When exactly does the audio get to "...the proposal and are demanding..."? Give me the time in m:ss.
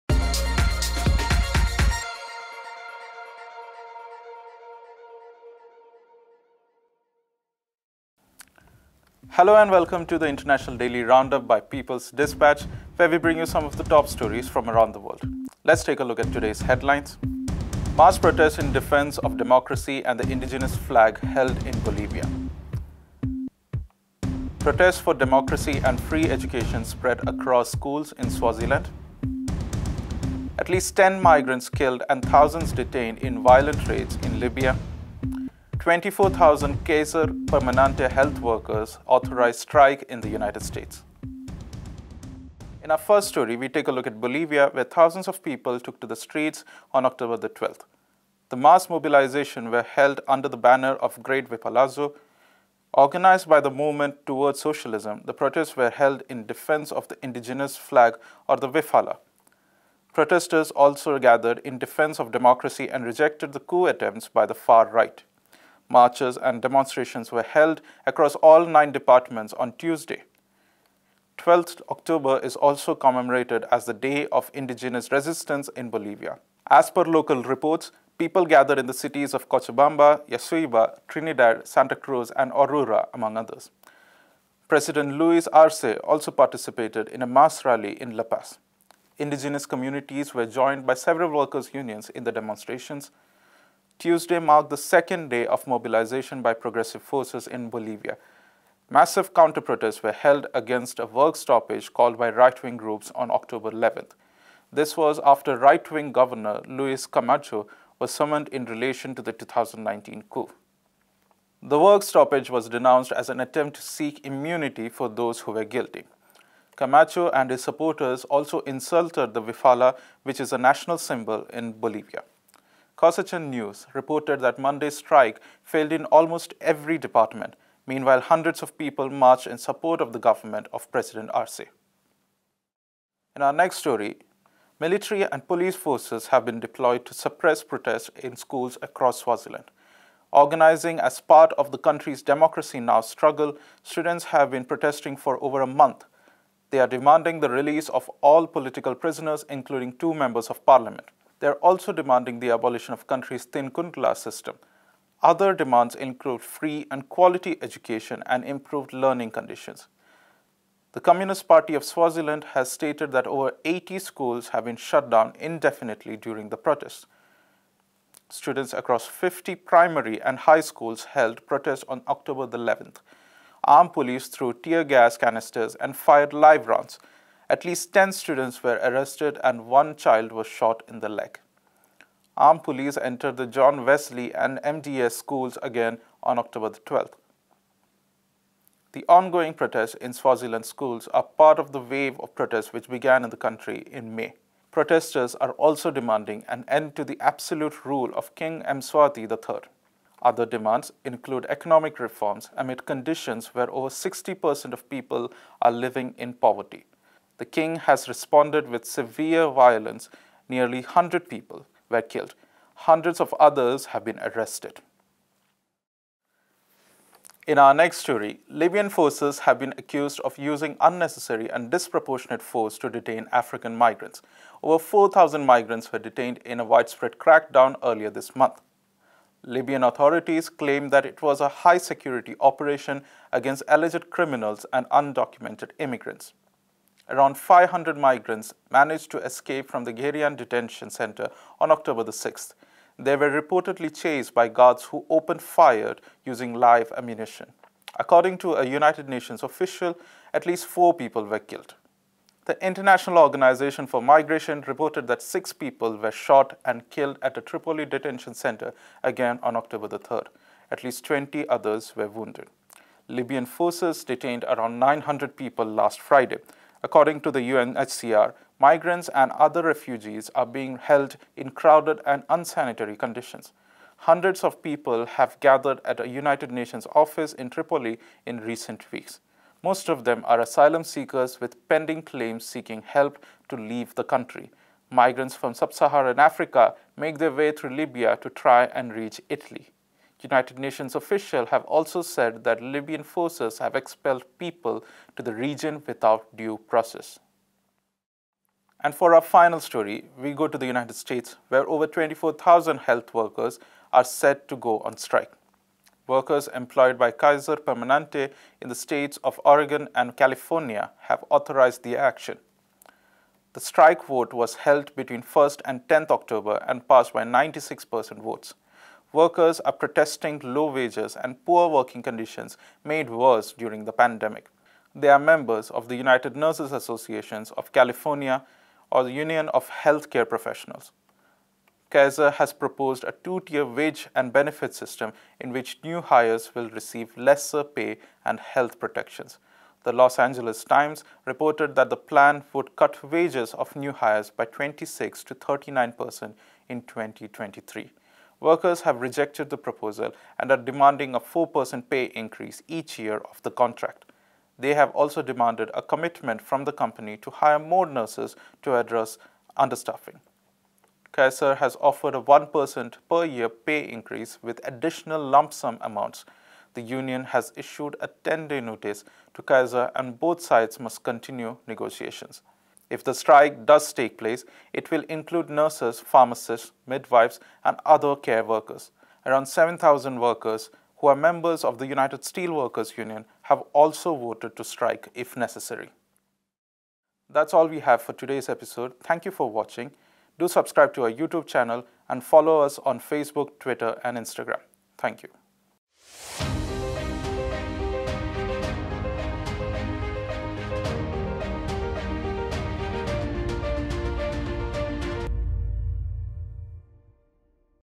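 5:49.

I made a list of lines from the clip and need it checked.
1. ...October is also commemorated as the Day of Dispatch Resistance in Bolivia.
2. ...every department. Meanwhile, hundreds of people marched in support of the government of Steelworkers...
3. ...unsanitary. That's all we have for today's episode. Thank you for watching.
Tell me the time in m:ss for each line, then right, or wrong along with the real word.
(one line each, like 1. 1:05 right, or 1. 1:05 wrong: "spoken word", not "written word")
1. 1:11 wrong: "Indigenous", not "Dispatch"
2. 2:06 wrong: "President", not "Steelworkers"
3. 6:25 wrong: "necessary", not "unsanitary".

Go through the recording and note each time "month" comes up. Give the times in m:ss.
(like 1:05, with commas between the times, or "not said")
2:25, 3:48.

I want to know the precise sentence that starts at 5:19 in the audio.
Workers are protesting low wages and poor working conditions made worse during the pandemic.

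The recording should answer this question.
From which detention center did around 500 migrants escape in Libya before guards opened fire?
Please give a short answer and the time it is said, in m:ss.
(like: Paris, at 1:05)
Gerian, at 3:59.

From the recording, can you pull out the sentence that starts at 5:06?
Workers employed by Kaiser Permanente in the states of Oregon and California have authorized the action.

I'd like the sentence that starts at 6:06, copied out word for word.
The union has issued a 10-day notice to Kaiser and both sides must continue negotiations.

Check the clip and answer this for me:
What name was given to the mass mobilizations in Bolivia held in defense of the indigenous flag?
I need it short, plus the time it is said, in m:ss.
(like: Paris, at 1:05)
Great Wiphalazo, at 0:51.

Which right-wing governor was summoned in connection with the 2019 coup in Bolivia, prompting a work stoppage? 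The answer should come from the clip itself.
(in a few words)
Luis Camacho.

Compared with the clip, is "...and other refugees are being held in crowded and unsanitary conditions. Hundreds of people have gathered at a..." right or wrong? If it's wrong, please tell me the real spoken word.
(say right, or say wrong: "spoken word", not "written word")
right.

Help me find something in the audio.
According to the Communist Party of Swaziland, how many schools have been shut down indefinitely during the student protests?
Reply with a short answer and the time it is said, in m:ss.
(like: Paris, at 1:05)
over 80, at 2:43.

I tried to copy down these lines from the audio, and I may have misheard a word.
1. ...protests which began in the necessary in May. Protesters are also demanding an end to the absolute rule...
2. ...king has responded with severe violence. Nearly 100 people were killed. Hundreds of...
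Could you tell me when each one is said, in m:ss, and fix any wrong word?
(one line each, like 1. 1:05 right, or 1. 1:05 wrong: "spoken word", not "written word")
1. 3:12 wrong: "country", not "necessary"
2. 3:27 right.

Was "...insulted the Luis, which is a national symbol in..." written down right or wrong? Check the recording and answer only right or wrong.
wrong.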